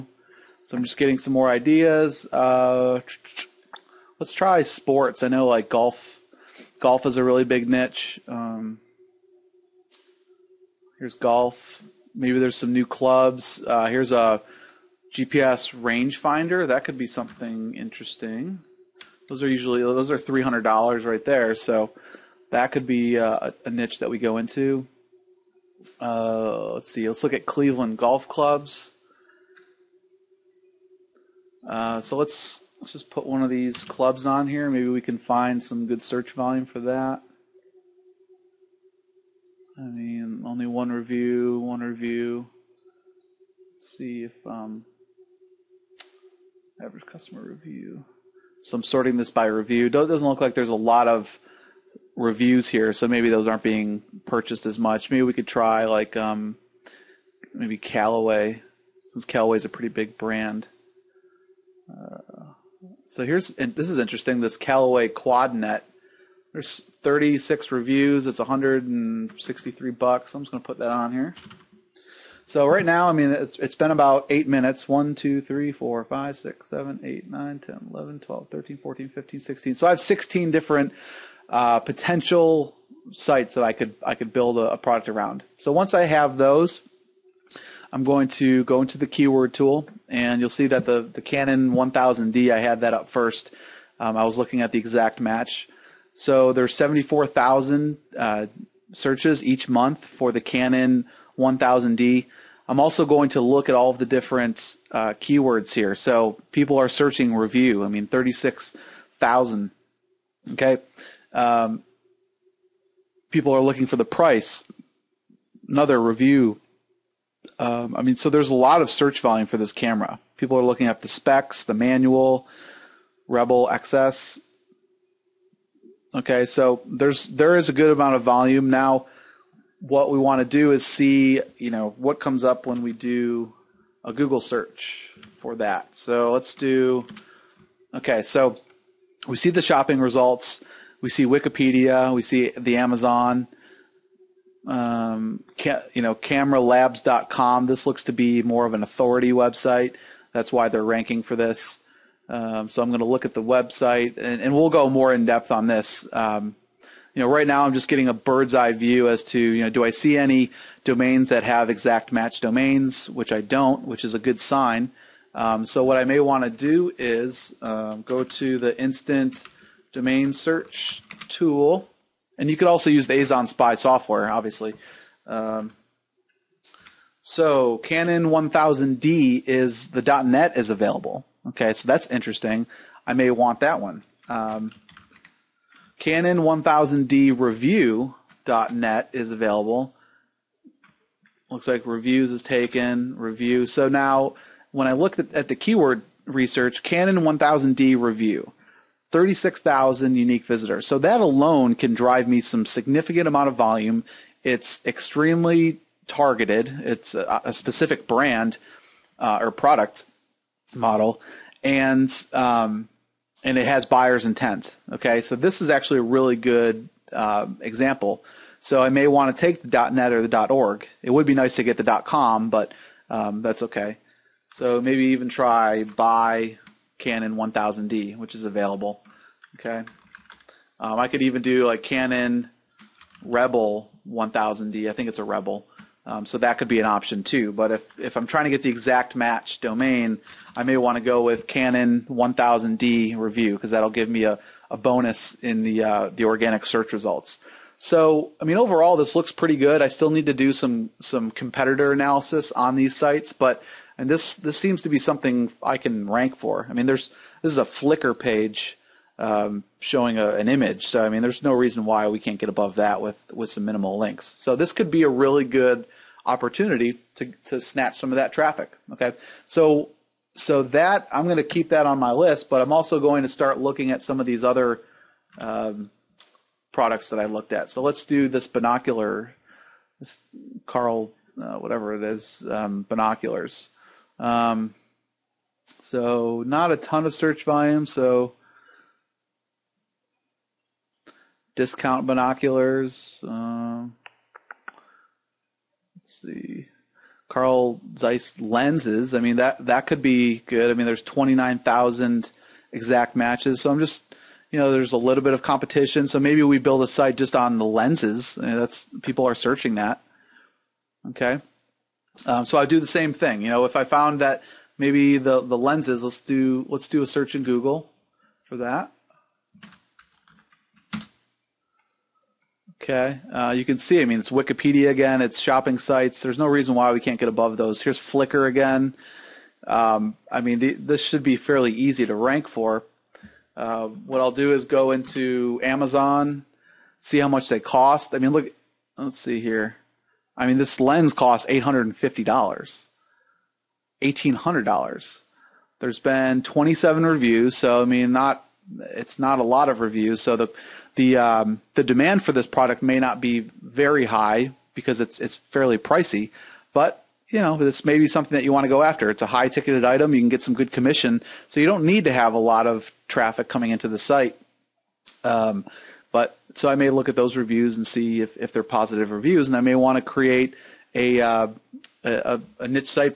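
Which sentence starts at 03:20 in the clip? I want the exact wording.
So that alone can drive me some significant amount of volume.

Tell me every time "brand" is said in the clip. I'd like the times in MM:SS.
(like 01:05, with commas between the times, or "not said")
01:00, 03:28.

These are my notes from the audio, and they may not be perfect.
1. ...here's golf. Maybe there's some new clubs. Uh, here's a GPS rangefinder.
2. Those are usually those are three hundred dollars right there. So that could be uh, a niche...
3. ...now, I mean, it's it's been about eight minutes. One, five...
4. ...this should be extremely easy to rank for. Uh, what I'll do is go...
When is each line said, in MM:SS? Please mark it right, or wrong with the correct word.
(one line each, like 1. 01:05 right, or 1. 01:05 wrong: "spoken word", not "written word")
1. 00:10 right
2. 00:19 right
3. 01:12 wrong: "two", not "five"
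4. 05:30 wrong: "fairly", not "extremely".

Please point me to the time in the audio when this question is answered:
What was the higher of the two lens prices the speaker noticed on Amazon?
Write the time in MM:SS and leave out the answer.
05:44.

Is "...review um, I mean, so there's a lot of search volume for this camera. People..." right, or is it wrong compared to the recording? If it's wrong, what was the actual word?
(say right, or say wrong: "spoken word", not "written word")
right.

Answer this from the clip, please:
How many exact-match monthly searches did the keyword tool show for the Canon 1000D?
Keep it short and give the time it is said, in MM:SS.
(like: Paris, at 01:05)
74,000, at 01:36.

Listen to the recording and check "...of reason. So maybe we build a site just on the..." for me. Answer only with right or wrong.
wrong.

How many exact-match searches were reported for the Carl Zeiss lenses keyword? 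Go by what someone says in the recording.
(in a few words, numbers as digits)
29,000.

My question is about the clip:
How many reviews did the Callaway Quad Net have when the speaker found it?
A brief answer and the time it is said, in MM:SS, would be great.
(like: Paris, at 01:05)
36, at 01:06.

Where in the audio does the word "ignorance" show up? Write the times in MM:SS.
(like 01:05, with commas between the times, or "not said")
not said.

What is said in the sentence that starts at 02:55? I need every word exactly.
Um, so Canon 1000D is the .NET is available.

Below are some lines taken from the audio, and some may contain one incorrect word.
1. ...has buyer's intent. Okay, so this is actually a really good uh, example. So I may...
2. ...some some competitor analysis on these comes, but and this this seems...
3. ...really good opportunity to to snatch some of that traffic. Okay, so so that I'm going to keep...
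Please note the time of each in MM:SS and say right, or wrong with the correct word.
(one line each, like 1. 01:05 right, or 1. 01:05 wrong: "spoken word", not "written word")
1. 03:33 right
2. 04:10 wrong: "sites", not "comes"
3. 04:25 right.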